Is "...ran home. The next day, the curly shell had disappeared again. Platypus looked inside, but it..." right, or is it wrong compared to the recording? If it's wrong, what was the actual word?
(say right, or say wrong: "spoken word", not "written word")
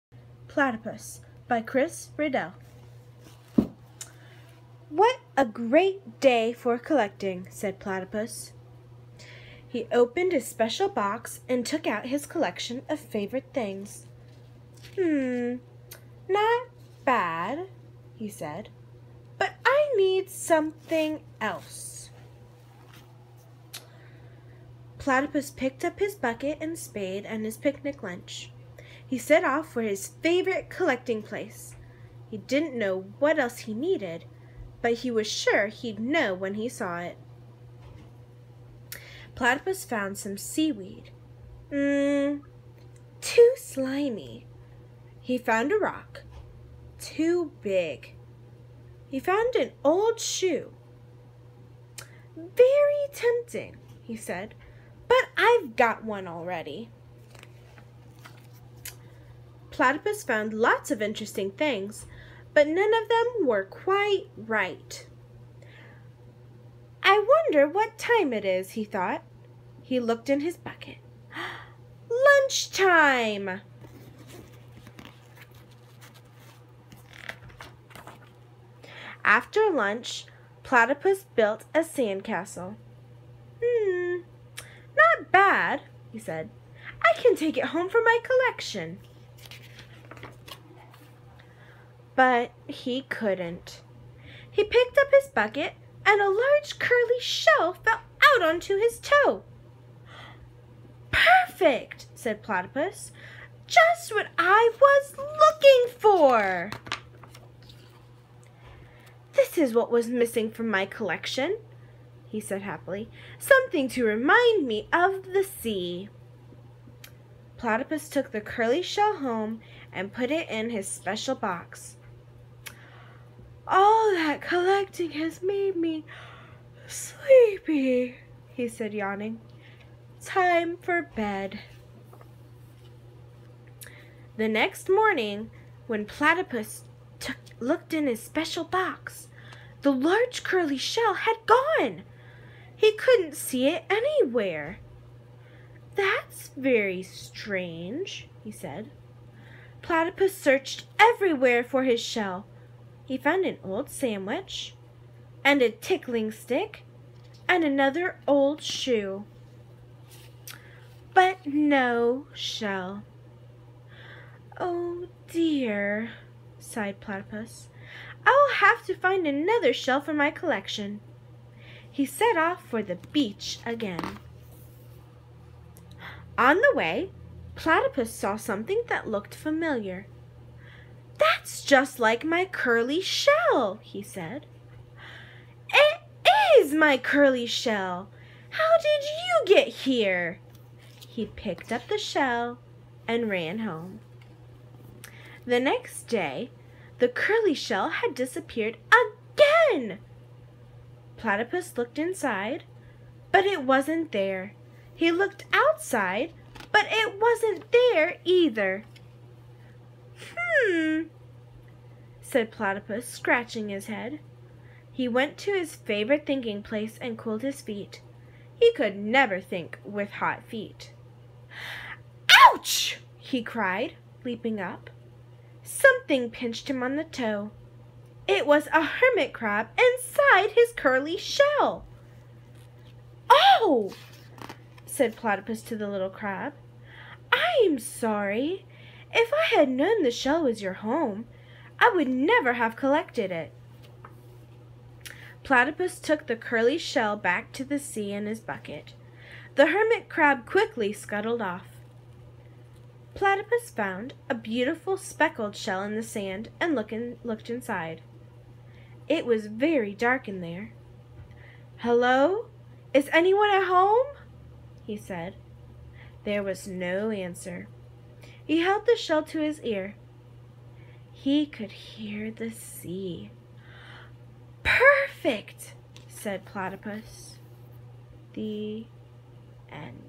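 right.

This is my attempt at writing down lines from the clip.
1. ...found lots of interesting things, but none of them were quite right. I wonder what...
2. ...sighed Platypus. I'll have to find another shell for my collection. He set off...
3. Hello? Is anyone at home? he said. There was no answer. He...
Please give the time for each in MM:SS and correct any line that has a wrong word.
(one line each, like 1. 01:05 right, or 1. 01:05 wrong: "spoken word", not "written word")
1. 01:00 right
2. 02:46 right
3. 04:21 right.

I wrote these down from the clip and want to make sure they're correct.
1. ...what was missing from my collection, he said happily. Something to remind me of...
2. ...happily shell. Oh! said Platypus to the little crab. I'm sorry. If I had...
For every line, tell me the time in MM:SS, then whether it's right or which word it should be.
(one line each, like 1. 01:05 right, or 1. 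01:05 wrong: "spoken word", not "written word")
1. 01:49 right
2. 03:50 wrong: "curly", not "happily".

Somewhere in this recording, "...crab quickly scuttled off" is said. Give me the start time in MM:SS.
04:10.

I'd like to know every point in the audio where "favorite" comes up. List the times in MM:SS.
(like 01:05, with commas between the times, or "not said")
00:12, 00:30, 03:35.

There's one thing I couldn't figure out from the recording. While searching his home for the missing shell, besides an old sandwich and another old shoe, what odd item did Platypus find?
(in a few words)
A tickling stick.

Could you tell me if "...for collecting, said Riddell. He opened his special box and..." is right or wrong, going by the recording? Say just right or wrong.
wrong.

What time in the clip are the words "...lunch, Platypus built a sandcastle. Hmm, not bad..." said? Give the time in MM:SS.
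01:19.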